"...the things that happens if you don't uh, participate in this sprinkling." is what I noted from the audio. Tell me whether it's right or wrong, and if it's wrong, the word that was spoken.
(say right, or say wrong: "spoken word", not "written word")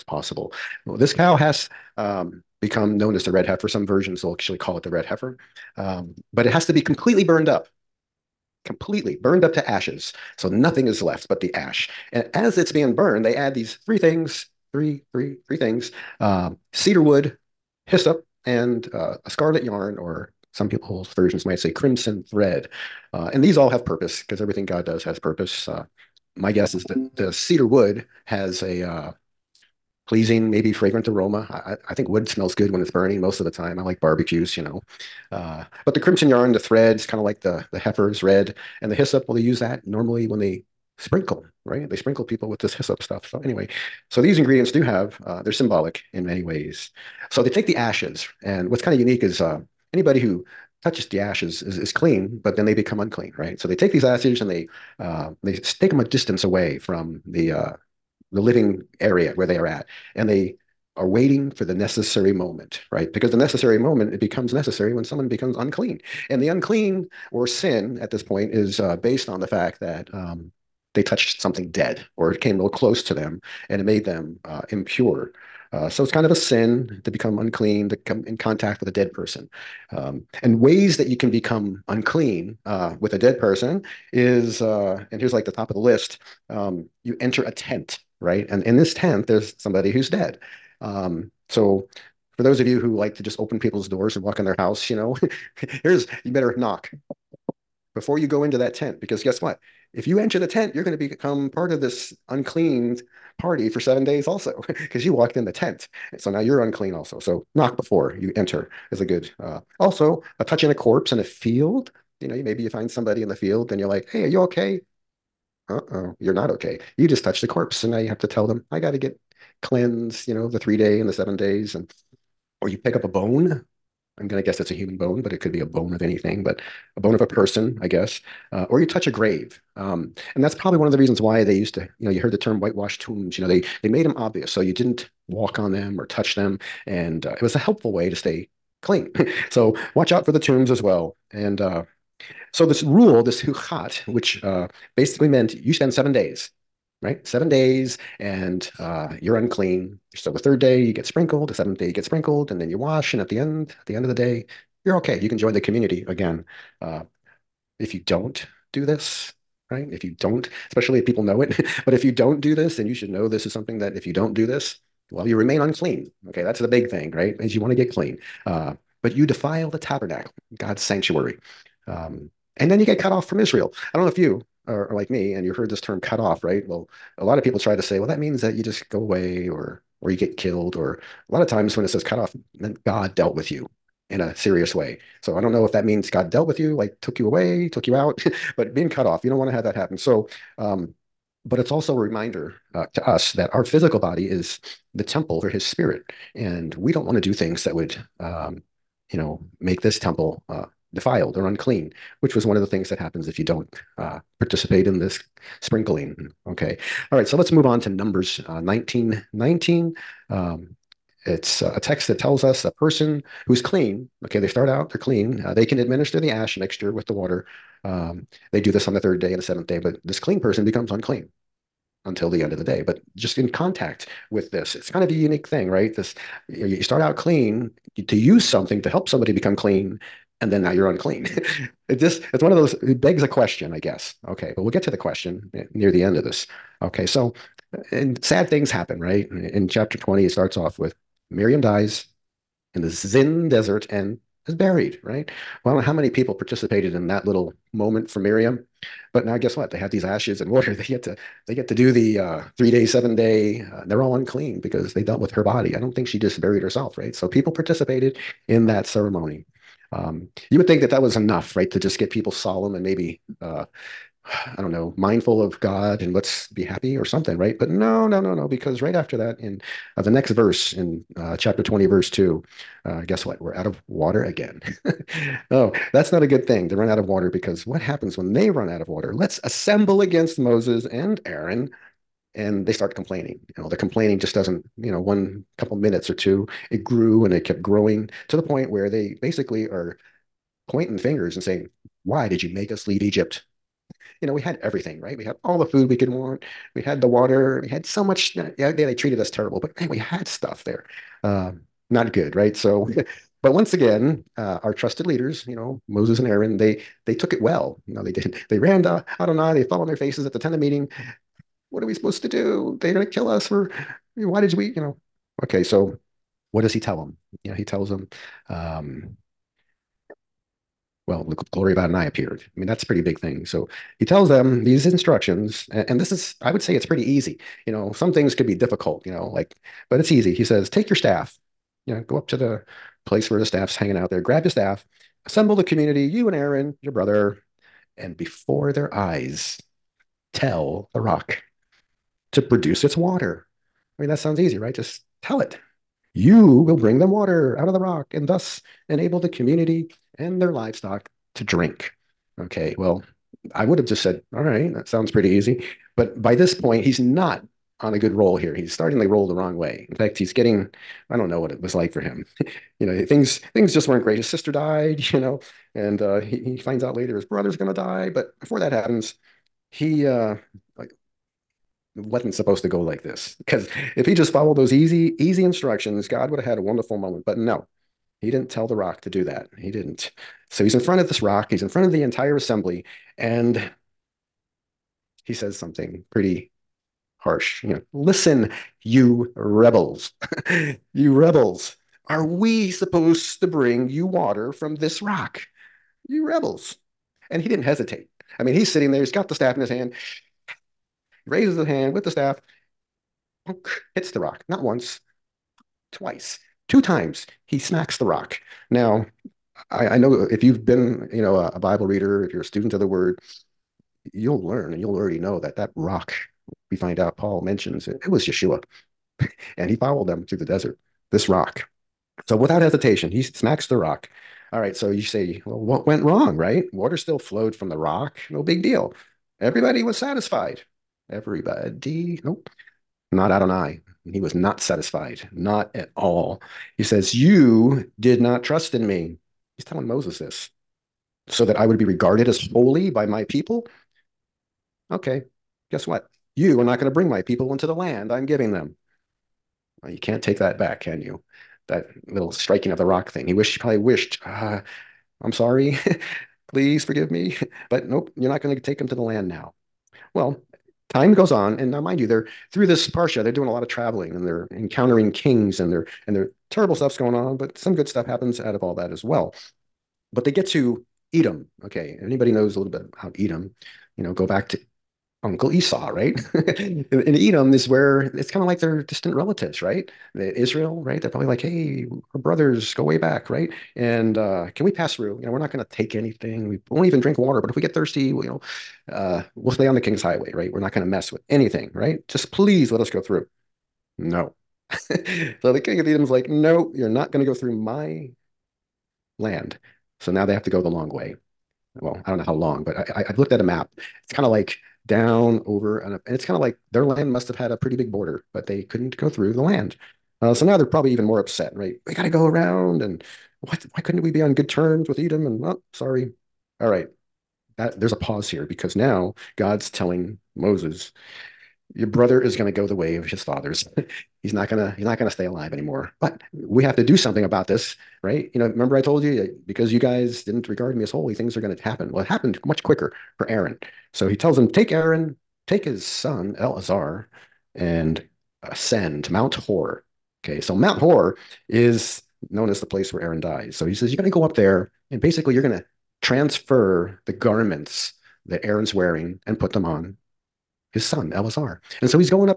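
right.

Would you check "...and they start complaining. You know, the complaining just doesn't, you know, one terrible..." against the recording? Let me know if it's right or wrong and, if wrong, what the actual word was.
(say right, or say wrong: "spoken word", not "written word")
wrong: "couple", not "terrible".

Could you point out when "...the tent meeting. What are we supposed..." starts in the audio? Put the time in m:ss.
5:10.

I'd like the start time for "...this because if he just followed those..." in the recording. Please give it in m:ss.
6:13.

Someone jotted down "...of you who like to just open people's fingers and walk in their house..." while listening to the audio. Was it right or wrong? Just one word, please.
wrong.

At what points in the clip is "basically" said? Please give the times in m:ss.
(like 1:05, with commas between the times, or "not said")
2:24, 4:49, 9:05.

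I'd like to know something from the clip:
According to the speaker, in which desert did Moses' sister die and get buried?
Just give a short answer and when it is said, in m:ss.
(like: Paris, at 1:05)
Zin Desert, at 4:02.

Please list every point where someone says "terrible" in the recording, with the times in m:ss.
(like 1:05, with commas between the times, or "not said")
4:59, 7:46.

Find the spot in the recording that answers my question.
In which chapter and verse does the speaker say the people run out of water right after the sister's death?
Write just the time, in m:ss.
4:31.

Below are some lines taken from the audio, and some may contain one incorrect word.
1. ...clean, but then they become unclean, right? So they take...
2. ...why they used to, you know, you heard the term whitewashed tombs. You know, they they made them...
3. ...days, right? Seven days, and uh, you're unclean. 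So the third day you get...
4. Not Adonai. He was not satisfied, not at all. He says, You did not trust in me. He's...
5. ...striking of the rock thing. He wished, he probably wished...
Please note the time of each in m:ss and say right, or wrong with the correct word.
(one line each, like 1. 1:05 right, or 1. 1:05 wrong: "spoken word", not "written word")
1. 0:51 right
2. 2:11 right
3. 2:26 right
4. 7:13 right
5. 7:32 right.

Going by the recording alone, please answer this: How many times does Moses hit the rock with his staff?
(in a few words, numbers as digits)
2.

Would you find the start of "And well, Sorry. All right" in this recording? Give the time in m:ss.
8:35.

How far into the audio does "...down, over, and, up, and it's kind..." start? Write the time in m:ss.
8:24.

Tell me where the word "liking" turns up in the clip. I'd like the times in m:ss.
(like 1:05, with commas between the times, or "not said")
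not said.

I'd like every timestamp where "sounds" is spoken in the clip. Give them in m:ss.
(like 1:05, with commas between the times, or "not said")
5:44, 5:54.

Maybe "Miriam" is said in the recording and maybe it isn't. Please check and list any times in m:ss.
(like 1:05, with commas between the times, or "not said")
4:01, 4:08.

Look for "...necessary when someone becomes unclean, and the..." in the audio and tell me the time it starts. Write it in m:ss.
1:04.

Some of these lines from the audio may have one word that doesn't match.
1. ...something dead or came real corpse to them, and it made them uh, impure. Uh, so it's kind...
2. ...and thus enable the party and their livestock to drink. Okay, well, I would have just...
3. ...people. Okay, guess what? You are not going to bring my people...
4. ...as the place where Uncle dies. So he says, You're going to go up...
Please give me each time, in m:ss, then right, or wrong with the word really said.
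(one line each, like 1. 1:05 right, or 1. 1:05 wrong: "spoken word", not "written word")
1. 1:11 wrong: "close", not "corpse"
2. 5:48 wrong: "community", not "party"
3. 7:23 right
4. 9:02 wrong: "Aaron", not "Uncle".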